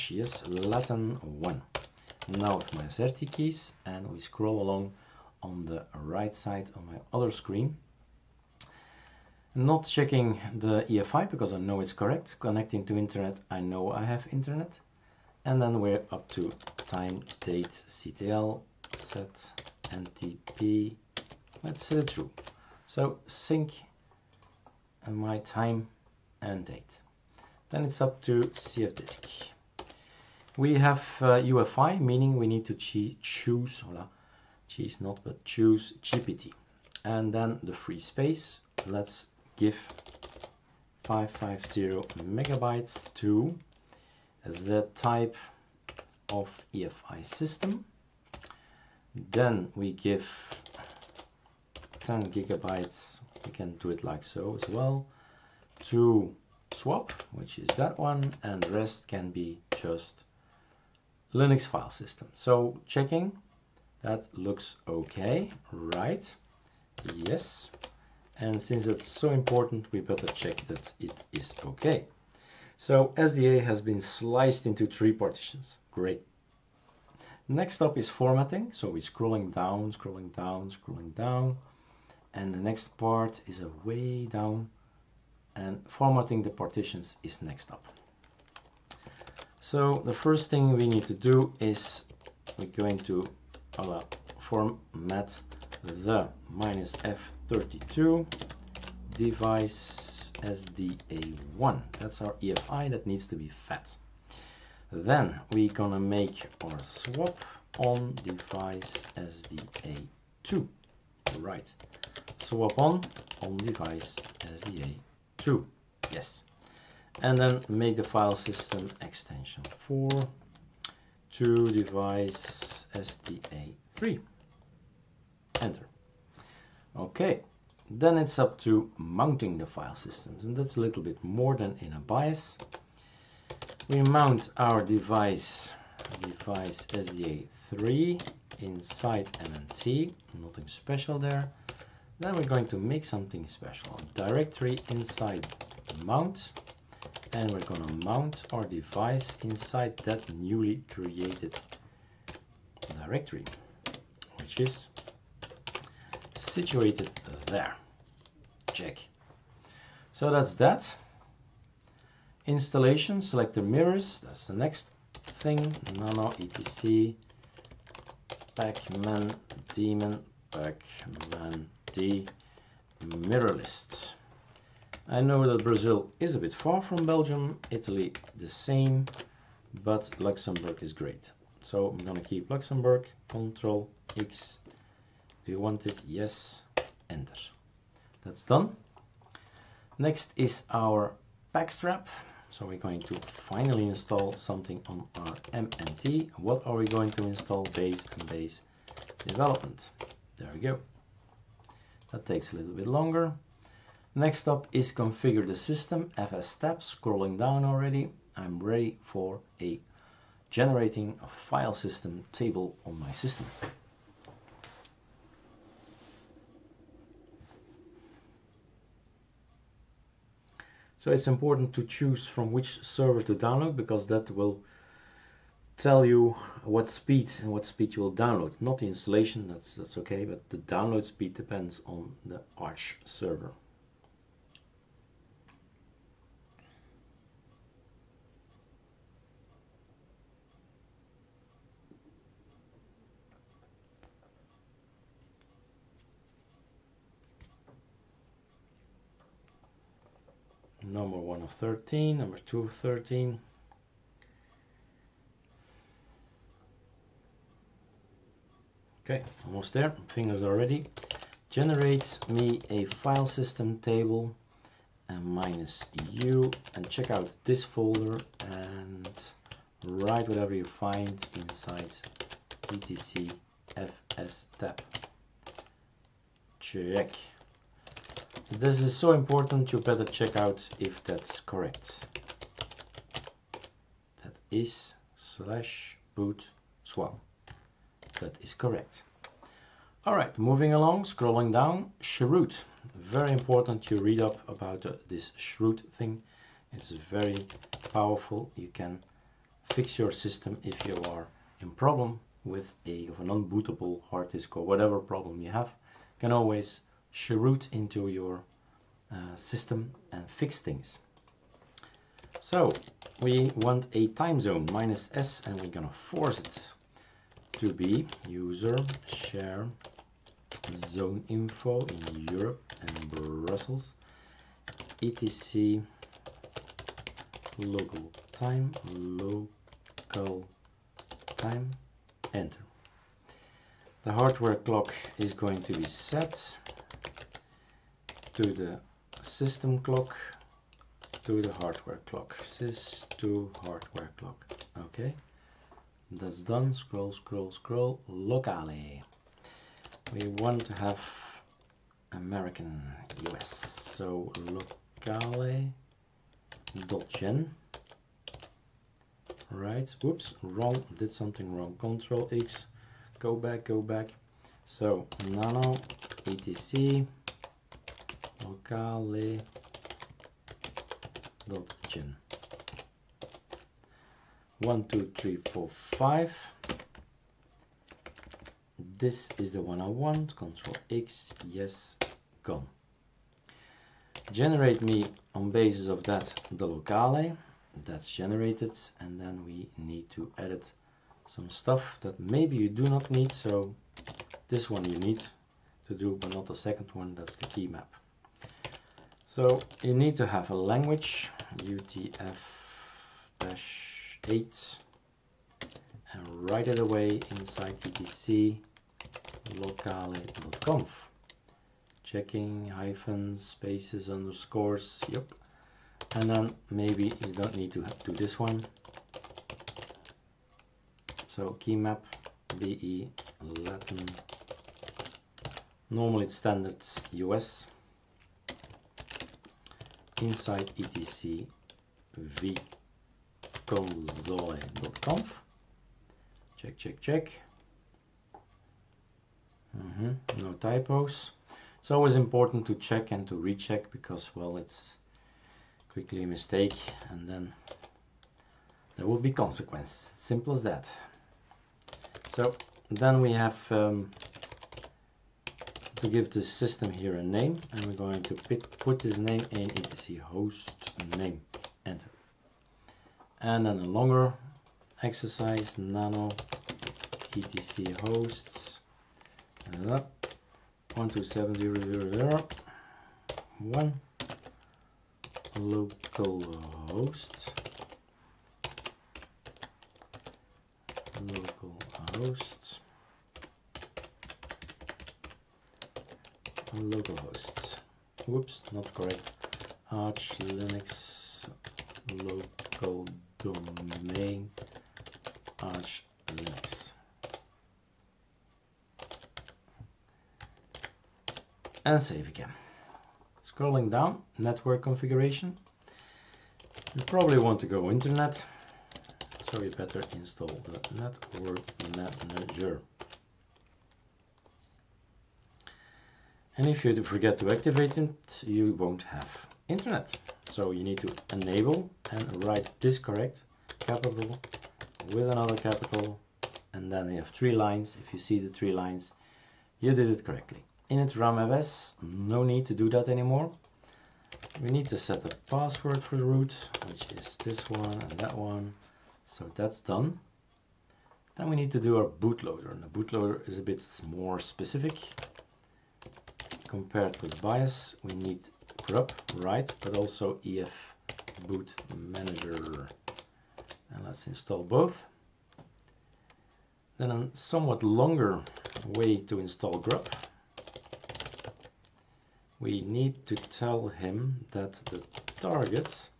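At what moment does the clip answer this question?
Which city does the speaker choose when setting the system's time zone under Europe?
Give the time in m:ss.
5:23.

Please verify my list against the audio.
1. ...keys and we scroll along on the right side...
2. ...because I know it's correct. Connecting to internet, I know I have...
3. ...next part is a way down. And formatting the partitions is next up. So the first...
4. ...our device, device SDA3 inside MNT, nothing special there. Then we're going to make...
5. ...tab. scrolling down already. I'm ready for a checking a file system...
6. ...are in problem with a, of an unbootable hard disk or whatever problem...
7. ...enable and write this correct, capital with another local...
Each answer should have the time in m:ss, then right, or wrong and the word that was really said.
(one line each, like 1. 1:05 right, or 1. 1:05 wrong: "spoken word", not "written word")
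1. 0:03 right
2. 0:11 right
3. 1:22 right
4. 2:14 right
5. 3:26 wrong: "generating", not "checking"
6. 5:01 right
7. 8:41 wrong: "capital", not "local".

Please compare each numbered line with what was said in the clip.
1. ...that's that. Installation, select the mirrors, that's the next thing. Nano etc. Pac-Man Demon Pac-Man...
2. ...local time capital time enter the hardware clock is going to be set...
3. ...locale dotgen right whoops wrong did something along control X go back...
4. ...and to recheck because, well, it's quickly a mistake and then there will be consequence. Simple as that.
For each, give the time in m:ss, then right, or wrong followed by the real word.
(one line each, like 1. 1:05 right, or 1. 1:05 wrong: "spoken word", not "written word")
1. 2:40 right
2. 5:27 wrong: "local", not "capital"
3. 5:54 wrong: "wrong", not "along"
4. 7:23 right.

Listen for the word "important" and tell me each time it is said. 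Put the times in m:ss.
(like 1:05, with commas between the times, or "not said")
1:09, 3:41, 4:39, 4:53, 7:22.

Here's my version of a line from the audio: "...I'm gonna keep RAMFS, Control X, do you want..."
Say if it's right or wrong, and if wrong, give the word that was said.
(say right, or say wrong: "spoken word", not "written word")
wrong: "Luxembourg", not "RAMFS".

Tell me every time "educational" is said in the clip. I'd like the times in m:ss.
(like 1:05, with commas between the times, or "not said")
not said.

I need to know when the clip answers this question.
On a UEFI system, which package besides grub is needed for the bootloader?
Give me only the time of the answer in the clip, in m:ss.
9:10.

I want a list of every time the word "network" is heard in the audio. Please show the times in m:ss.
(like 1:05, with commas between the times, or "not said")
8:24, 8:30.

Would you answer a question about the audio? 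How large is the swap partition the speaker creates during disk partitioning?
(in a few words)
10 gigabytes.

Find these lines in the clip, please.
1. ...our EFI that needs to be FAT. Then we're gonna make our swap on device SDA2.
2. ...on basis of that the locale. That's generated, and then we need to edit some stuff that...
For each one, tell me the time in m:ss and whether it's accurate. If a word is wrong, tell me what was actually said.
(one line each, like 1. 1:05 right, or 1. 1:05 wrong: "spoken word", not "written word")
1. 1:42 right
2. 6:25 right.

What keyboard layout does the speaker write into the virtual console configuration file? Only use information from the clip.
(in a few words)
BE Latin.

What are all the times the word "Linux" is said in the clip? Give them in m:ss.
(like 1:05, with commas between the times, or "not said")
1:01, 8:10, 8:16.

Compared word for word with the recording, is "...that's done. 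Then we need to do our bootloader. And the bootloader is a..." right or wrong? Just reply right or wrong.
right.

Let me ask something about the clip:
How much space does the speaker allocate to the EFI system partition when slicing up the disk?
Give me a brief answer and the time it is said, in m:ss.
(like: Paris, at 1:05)
550 megabytes, at 0:41.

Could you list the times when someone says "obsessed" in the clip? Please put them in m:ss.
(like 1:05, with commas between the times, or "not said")
not said.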